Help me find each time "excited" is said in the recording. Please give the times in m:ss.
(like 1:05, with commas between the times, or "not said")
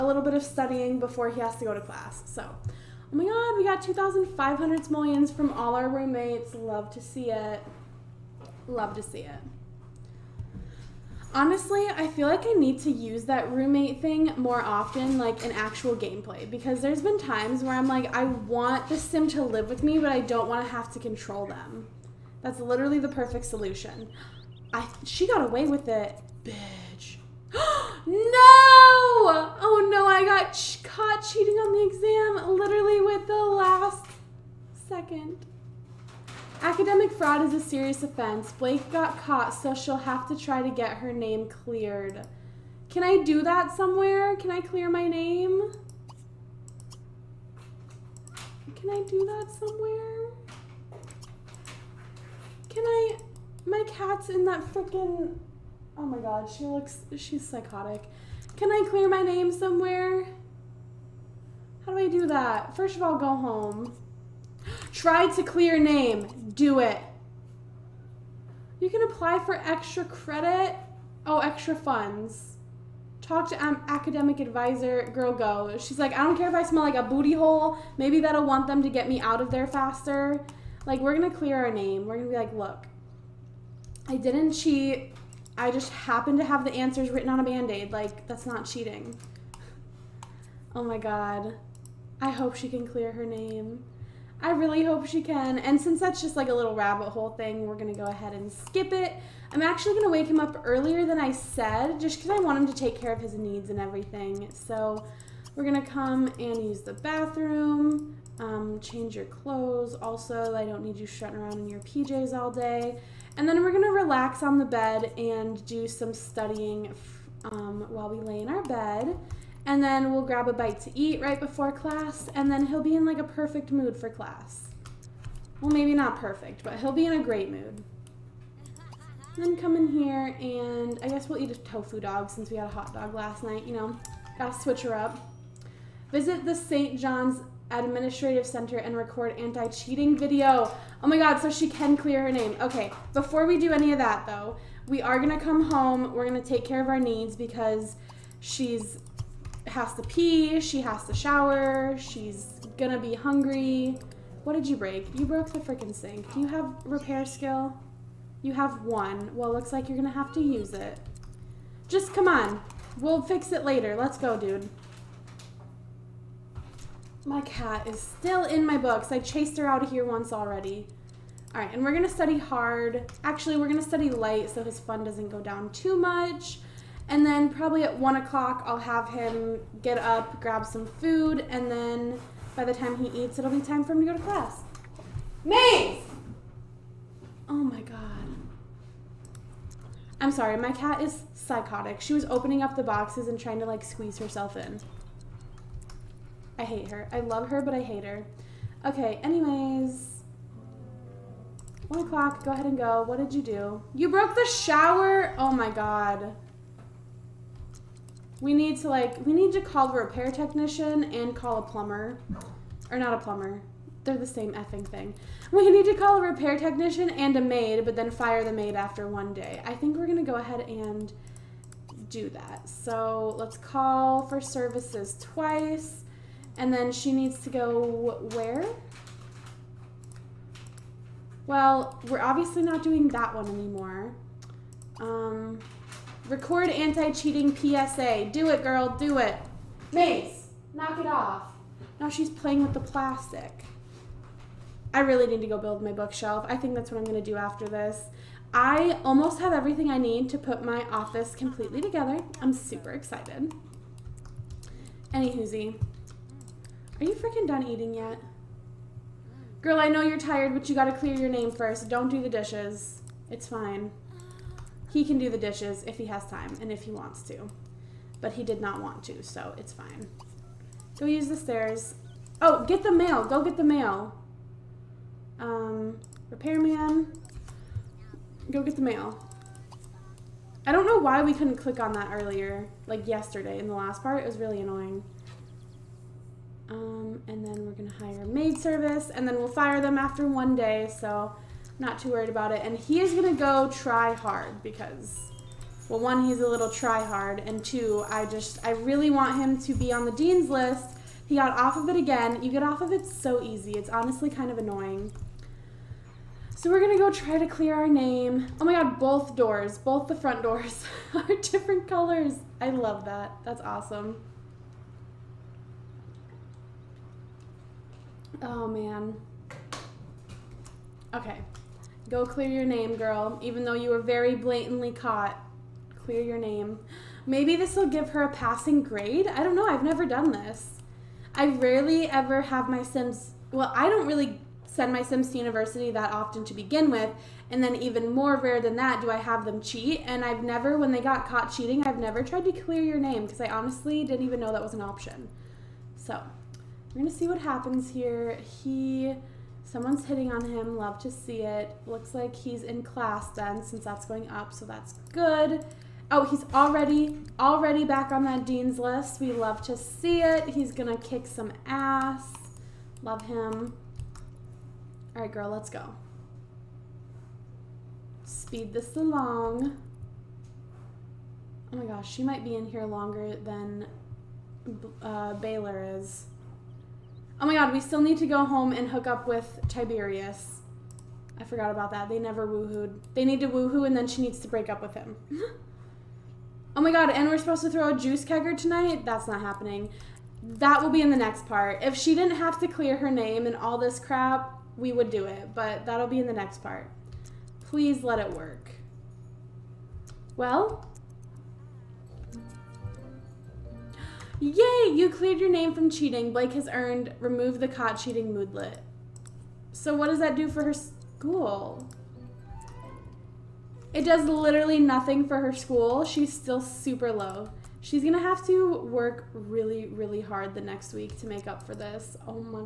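4:12.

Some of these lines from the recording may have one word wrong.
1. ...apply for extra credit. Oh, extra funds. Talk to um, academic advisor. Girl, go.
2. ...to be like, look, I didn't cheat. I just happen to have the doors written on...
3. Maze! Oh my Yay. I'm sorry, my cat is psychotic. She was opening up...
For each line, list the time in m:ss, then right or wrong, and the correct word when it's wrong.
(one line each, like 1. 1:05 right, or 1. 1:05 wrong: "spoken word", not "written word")
1. 1:09 right
2. 1:22 wrong: "answers", not "doors"
3. 3:05 wrong: "God", not "Yay".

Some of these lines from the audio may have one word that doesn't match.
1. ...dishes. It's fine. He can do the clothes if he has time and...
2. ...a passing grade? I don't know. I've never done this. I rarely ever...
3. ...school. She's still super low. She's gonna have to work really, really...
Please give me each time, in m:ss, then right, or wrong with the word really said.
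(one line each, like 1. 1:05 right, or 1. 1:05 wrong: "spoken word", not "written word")
1. 4:22 wrong: "dishes", not "clothes"
2. 5:28 right
3. 6:55 right.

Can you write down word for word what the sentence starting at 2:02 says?
And then he'll be in like a perfect mood for class.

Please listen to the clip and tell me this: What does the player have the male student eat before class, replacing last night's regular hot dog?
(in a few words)
tofu dog.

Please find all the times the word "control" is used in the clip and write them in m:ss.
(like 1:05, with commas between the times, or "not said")
0:20.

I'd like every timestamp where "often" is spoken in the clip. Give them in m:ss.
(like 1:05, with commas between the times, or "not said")
0:14, 5:36.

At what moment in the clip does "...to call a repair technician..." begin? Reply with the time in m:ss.
3:35.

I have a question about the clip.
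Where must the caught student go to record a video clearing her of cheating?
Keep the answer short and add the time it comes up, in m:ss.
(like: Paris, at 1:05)
St. John's administrative center, at 2:16.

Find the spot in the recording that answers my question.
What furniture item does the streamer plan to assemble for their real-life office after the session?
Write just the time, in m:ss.
4:05.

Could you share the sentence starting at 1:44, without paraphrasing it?
So we're going to come and use the bathroom, um, change your clothes.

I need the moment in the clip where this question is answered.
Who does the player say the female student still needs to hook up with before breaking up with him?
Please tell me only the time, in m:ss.
6:19.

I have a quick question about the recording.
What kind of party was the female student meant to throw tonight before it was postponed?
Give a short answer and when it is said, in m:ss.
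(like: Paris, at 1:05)
juice kegger, at 6:27.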